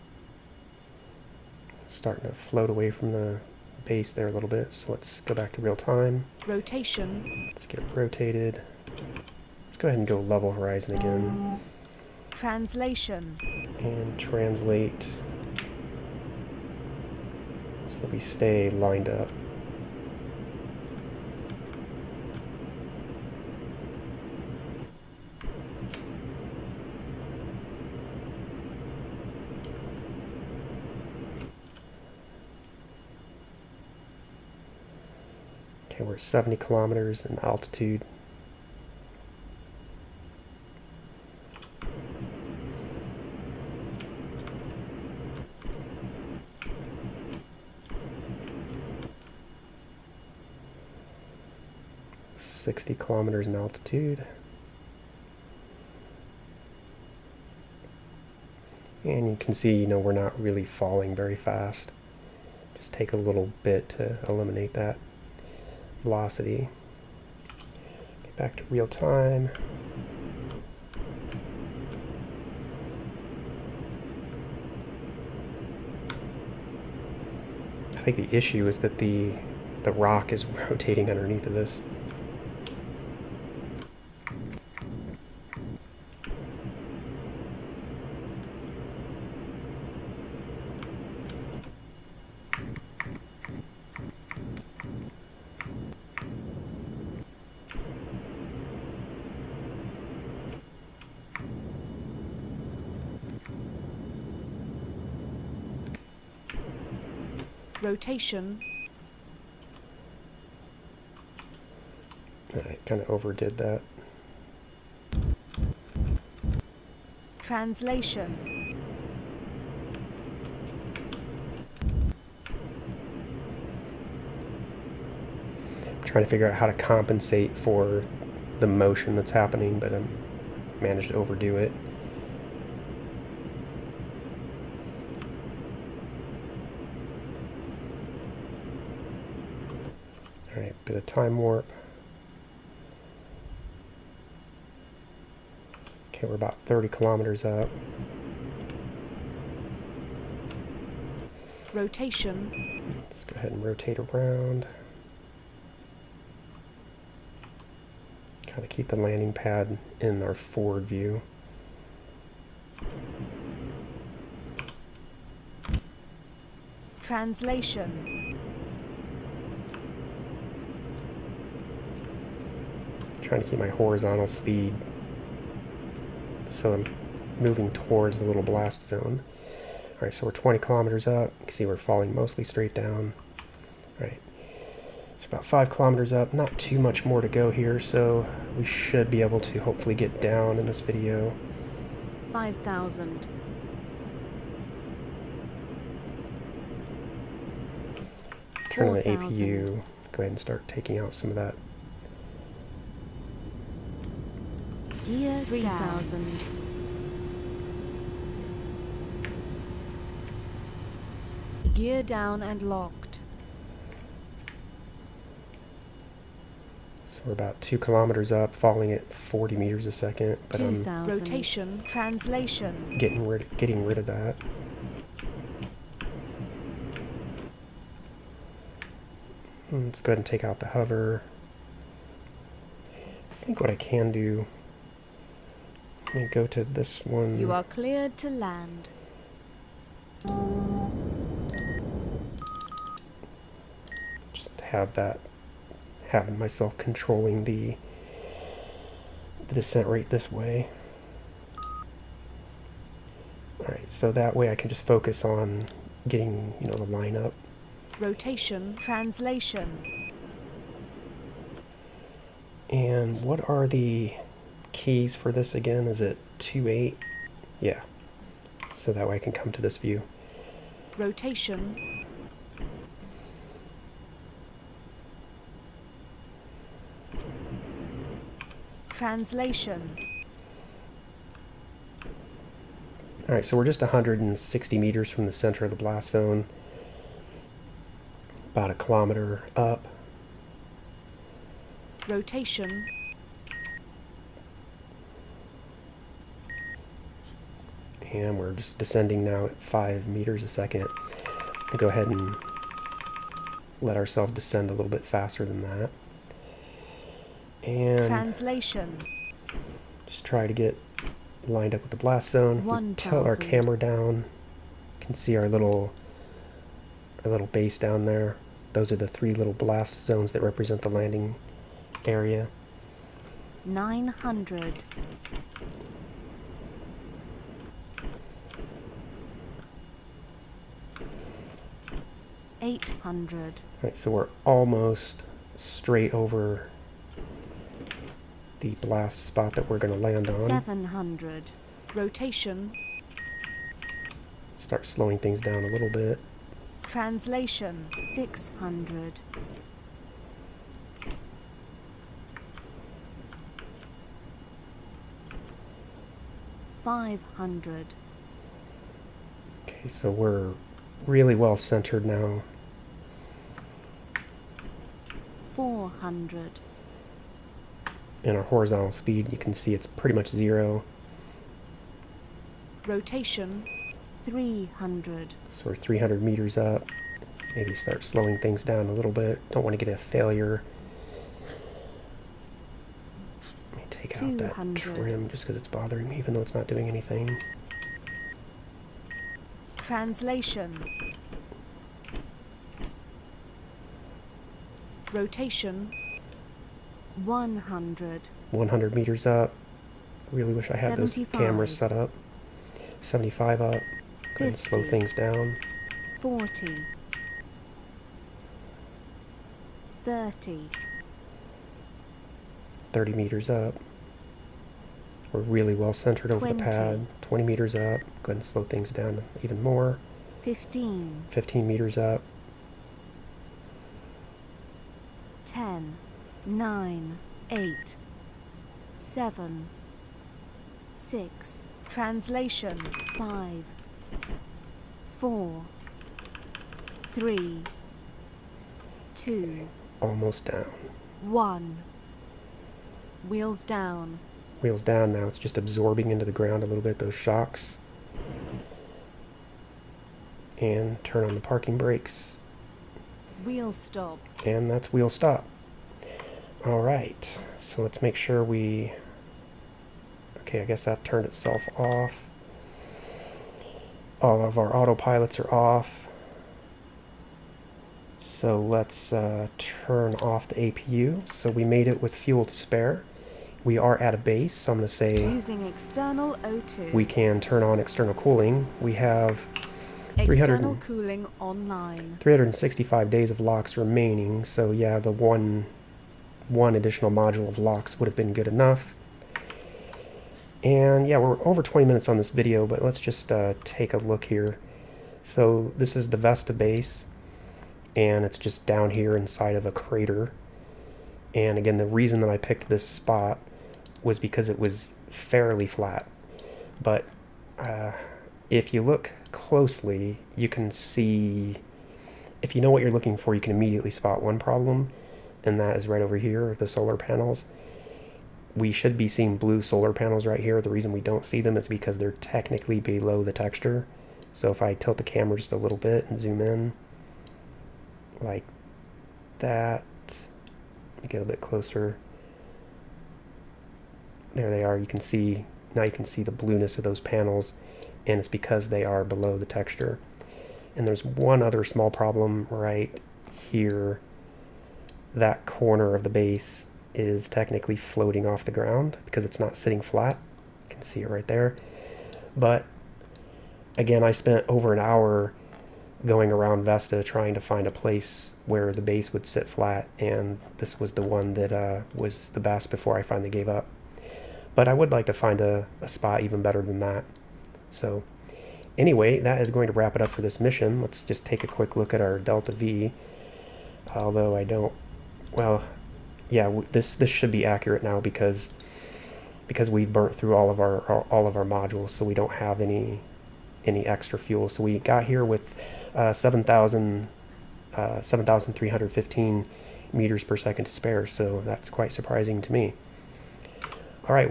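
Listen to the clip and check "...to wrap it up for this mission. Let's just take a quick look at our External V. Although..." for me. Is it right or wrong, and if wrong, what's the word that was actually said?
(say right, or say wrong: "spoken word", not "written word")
wrong: "Delta", not "External".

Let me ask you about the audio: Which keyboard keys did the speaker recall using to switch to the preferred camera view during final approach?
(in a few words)
2, 8.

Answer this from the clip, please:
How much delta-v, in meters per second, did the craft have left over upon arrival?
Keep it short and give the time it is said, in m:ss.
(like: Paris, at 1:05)
7,315, at 9:47.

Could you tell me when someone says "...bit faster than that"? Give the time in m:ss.
5:04.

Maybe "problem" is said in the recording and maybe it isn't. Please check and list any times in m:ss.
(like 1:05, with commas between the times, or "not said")
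8:34, 9:01.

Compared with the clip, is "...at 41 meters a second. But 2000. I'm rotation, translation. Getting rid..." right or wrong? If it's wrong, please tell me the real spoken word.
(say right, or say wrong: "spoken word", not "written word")
wrong: "40", not "41".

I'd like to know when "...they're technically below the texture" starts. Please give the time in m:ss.
8:41.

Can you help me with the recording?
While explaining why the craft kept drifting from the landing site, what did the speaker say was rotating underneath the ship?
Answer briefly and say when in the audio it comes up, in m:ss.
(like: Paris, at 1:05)
the rock, at 1:19.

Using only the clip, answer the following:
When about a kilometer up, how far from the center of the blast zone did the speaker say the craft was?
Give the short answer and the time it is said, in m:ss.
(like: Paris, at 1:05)
160 meters, at 4:43.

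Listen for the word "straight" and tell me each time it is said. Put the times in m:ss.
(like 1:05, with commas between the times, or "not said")
3:02, 5:35.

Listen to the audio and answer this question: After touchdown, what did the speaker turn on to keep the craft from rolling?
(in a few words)
parking brakes.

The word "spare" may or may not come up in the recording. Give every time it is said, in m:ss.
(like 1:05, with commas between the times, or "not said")
7:52, 9:50.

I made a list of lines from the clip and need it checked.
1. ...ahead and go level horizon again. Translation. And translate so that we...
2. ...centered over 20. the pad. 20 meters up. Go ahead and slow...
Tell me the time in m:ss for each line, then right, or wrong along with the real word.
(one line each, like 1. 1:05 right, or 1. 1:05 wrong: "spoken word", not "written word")
1. 0:09 right
2. 6:55 right.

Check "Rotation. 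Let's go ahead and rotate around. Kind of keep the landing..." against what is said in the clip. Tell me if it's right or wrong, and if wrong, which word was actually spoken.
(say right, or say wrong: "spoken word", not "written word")
right.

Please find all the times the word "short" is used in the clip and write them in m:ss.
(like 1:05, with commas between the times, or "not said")
not said.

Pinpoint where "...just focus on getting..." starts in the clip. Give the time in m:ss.
4:14.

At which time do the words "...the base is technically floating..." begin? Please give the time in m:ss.
9:06.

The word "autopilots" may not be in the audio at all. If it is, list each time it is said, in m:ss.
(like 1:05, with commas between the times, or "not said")
7:44.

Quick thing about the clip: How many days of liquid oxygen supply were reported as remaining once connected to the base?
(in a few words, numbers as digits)
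365.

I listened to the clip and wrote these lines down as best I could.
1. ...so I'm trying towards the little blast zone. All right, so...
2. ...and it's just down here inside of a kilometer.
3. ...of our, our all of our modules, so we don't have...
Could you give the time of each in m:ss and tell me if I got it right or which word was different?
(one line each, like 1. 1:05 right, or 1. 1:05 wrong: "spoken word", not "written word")
1. 2:56 wrong: "moving", not "trying"
2. 8:17 wrong: "crater", not "kilometer"
3. 9:40 right.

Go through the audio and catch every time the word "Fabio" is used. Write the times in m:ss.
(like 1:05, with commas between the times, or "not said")
not said.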